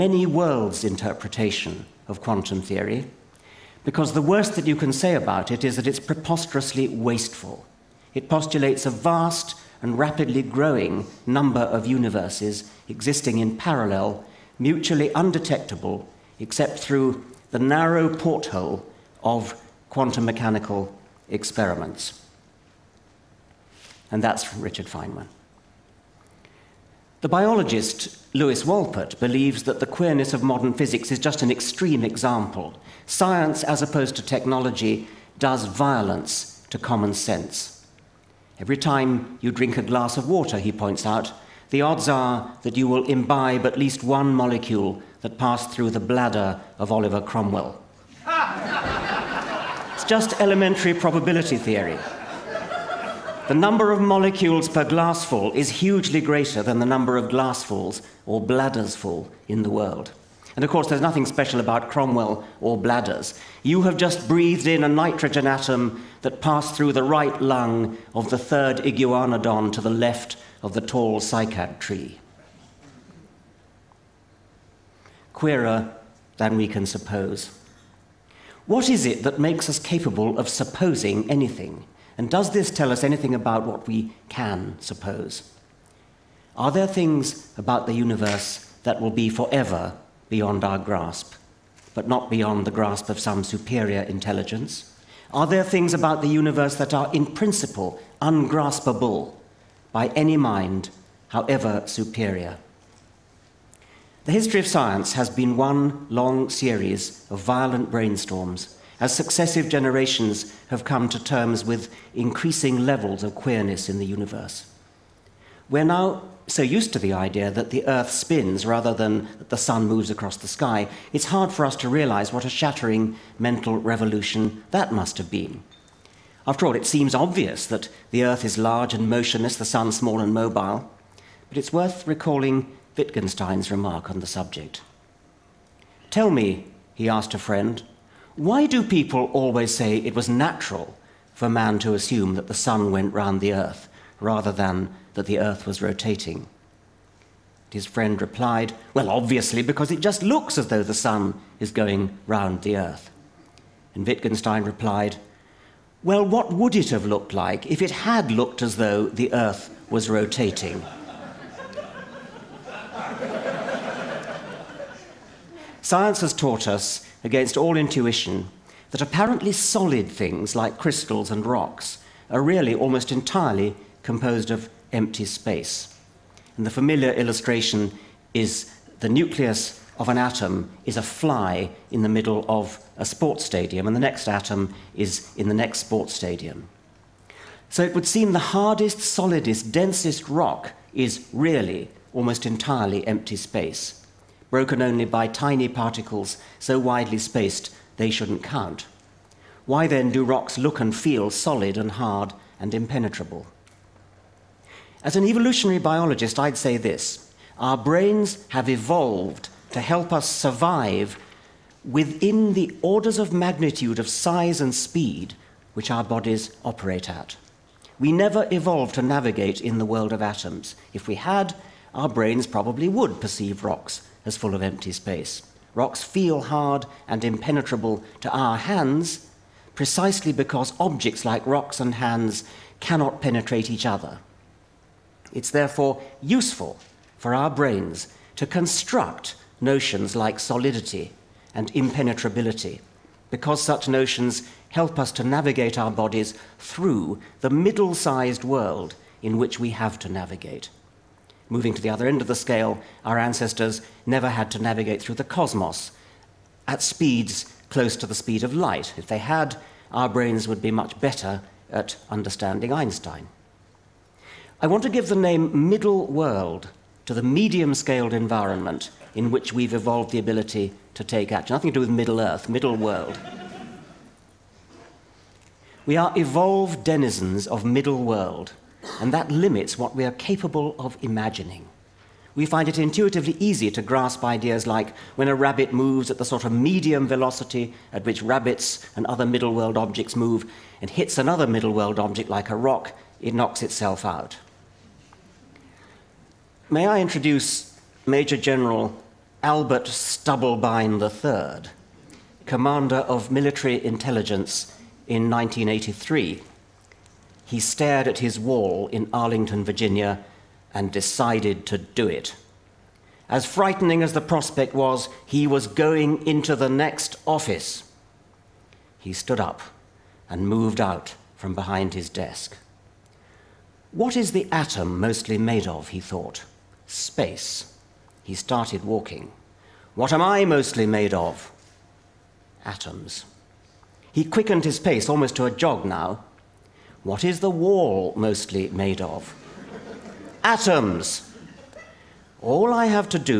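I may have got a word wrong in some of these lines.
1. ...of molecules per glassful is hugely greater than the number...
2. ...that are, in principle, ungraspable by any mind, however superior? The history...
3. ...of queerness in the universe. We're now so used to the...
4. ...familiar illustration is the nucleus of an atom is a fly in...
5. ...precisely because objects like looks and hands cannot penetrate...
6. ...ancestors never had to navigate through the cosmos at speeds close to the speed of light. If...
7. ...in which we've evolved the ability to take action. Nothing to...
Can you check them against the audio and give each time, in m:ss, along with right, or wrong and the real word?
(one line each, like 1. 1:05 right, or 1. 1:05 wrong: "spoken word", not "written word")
1. 0:53 right
2. 1:36 right
3. 1:53 right
4. 2:56 right
5. 3:49 wrong: "rocks", not "looks"
6. 4:13 right
7. 4:29 right.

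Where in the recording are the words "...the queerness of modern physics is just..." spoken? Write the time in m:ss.
0:29.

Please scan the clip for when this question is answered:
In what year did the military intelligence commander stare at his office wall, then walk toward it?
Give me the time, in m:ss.
5:05.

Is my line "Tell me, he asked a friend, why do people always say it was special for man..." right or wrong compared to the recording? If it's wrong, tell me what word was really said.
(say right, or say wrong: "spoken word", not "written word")
wrong: "natural", not "special".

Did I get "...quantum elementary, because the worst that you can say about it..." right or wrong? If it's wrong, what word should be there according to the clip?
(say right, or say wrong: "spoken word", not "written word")
wrong: "theory", not "elementary".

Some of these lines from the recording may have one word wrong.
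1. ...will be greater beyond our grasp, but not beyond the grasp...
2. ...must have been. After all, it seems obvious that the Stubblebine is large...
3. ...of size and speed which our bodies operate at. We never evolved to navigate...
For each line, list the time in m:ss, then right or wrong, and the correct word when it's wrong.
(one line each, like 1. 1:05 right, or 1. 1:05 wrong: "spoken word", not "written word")
1. 1:29 wrong: "forever", not "greater"
2. 2:04 wrong: "Earth", not "Stubblebine"
3. 3:33 right.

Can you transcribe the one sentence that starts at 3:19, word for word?
Why then do rocks look and feel solid and hard and impenetrable?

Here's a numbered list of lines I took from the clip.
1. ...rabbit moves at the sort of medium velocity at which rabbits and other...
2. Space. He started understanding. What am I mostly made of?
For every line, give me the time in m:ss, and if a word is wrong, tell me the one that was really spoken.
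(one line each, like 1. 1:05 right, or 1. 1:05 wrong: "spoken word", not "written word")
1. 4:45 right
2. 5:26 wrong: "walking", not "understanding".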